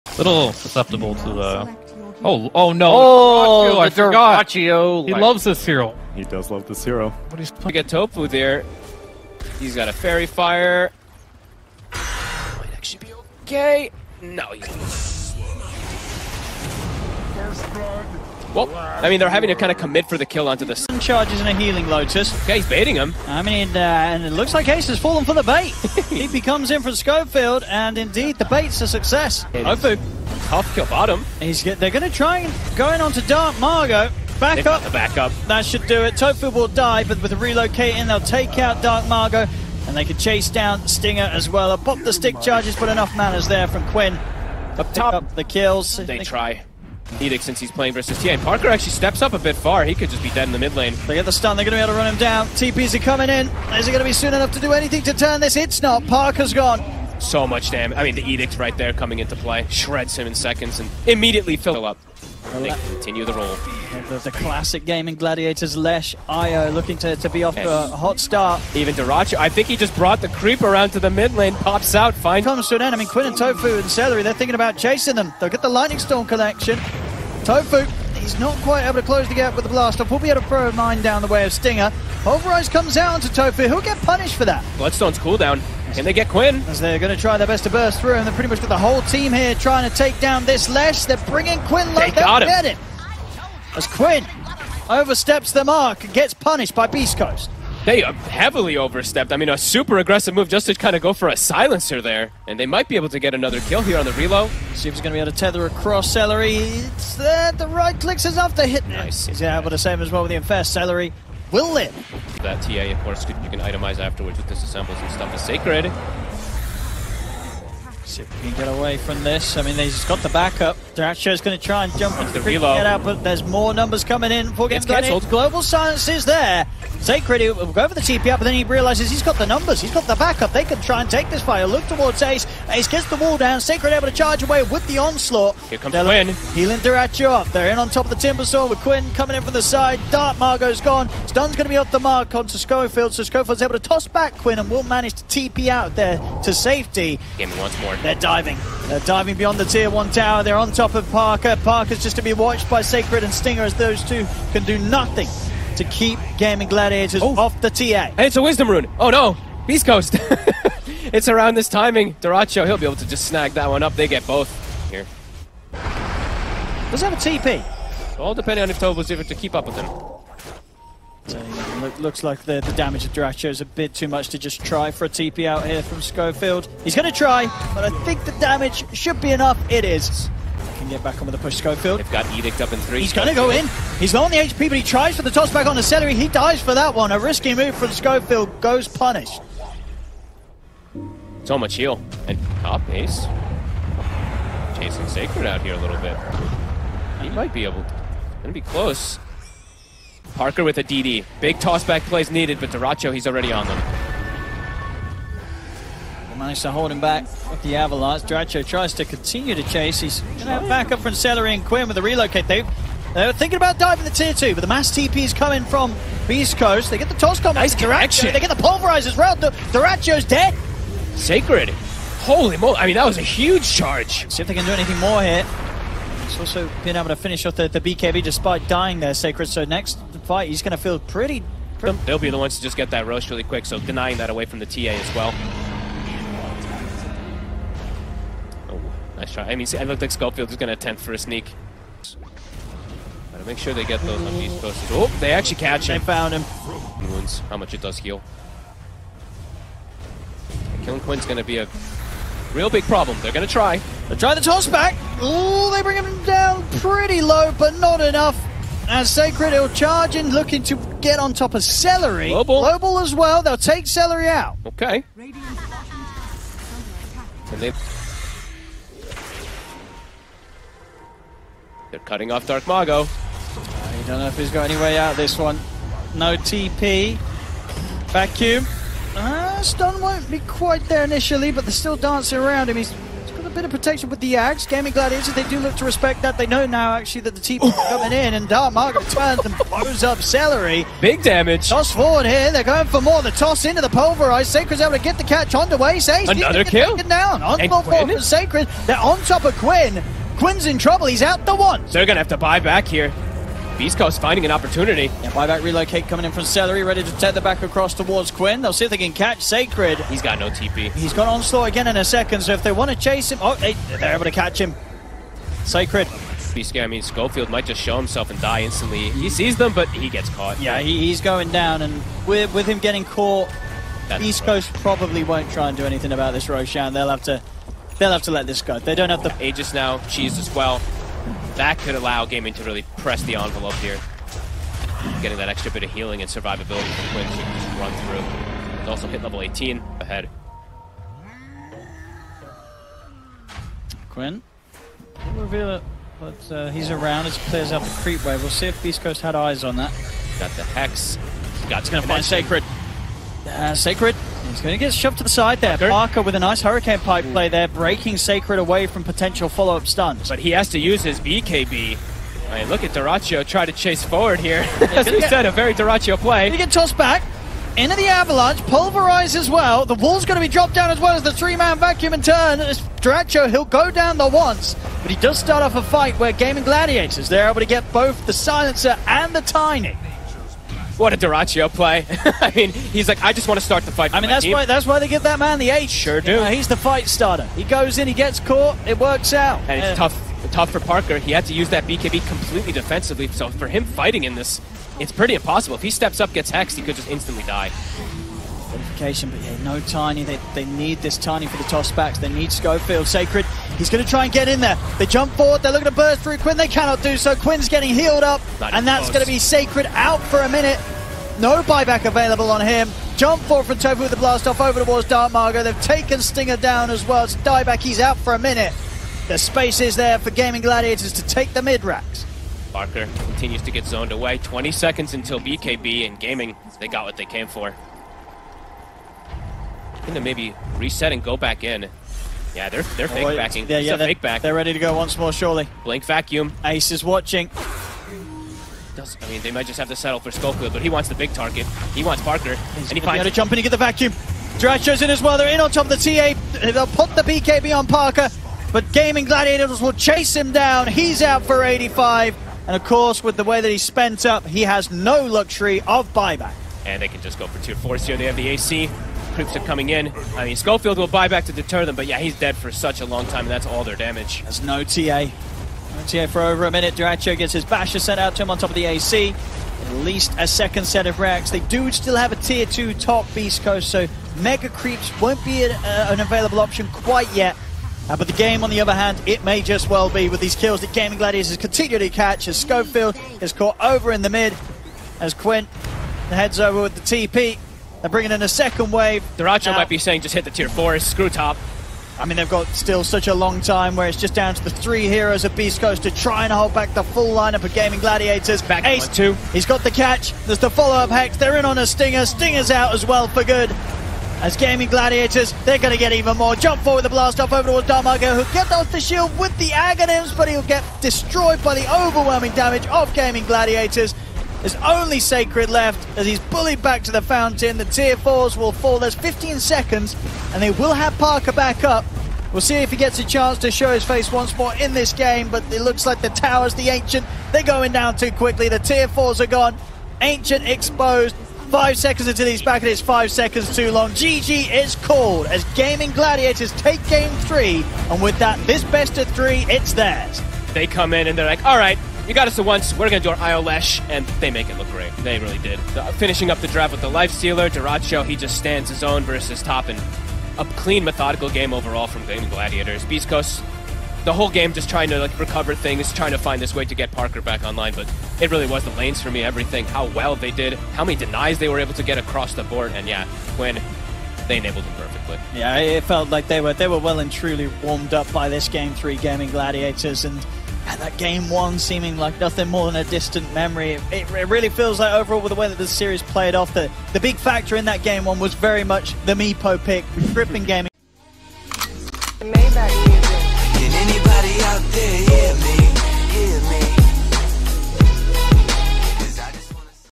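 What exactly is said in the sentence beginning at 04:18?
And Sacred will charge in, looking to get on top of Seleri.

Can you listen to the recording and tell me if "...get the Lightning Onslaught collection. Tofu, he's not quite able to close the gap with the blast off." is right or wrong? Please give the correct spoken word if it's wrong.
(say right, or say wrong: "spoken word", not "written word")
wrong: "Storm", not "Onslaught".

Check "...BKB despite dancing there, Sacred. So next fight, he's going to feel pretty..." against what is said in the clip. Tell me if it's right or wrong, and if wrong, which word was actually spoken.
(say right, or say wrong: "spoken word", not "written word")
wrong: "dying", not "dancing".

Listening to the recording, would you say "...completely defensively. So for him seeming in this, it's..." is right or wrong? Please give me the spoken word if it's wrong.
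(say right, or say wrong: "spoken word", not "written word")
wrong: "fighting", not "seeming".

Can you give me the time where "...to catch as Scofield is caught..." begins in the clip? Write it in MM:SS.
08:01.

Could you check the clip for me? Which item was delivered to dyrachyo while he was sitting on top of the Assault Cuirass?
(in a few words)
Basher.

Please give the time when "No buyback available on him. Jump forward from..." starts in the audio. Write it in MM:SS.
06:51.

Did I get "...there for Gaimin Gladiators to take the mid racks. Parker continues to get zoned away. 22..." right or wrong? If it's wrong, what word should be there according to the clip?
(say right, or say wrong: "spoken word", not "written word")
wrong: "20", not "22".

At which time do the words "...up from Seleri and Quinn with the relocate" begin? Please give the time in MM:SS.
03:30.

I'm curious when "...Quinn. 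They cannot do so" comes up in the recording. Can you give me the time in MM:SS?
06:46.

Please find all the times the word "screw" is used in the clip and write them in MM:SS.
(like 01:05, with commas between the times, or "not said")
08:10.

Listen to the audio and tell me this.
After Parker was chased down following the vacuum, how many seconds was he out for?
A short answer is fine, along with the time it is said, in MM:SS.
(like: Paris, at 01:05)
85, at 07:31.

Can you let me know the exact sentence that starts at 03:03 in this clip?
He's low on the HP, but he tries for the toss back on the Seleri.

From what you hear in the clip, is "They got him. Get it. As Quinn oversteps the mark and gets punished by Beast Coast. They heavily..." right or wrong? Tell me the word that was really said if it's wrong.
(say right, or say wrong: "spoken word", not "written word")
right.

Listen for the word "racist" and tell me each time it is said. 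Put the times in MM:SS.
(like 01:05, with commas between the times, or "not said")
not said.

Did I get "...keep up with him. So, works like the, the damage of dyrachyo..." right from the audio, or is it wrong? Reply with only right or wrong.
wrong.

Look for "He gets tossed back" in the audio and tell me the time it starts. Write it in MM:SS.
06:06.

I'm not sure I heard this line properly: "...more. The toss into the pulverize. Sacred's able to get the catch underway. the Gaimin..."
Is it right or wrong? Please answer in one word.
wrong.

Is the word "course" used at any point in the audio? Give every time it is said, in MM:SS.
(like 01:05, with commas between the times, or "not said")
01:53, 07:32.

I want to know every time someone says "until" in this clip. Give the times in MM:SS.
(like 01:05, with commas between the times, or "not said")
07:05, 08:52.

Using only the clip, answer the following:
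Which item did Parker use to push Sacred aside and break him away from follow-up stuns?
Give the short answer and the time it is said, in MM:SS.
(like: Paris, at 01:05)
Hurricane Pipe, at 05:56.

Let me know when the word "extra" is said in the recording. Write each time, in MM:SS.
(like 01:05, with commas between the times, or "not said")
05:35.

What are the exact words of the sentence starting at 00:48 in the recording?
Parker actually steps up a bit far.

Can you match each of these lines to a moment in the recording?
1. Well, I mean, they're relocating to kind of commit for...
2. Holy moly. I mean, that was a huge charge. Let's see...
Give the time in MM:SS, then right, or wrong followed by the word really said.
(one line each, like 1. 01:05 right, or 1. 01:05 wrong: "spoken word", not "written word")
1. 00:18 wrong: "having", not "relocating"
2. 03:42 right.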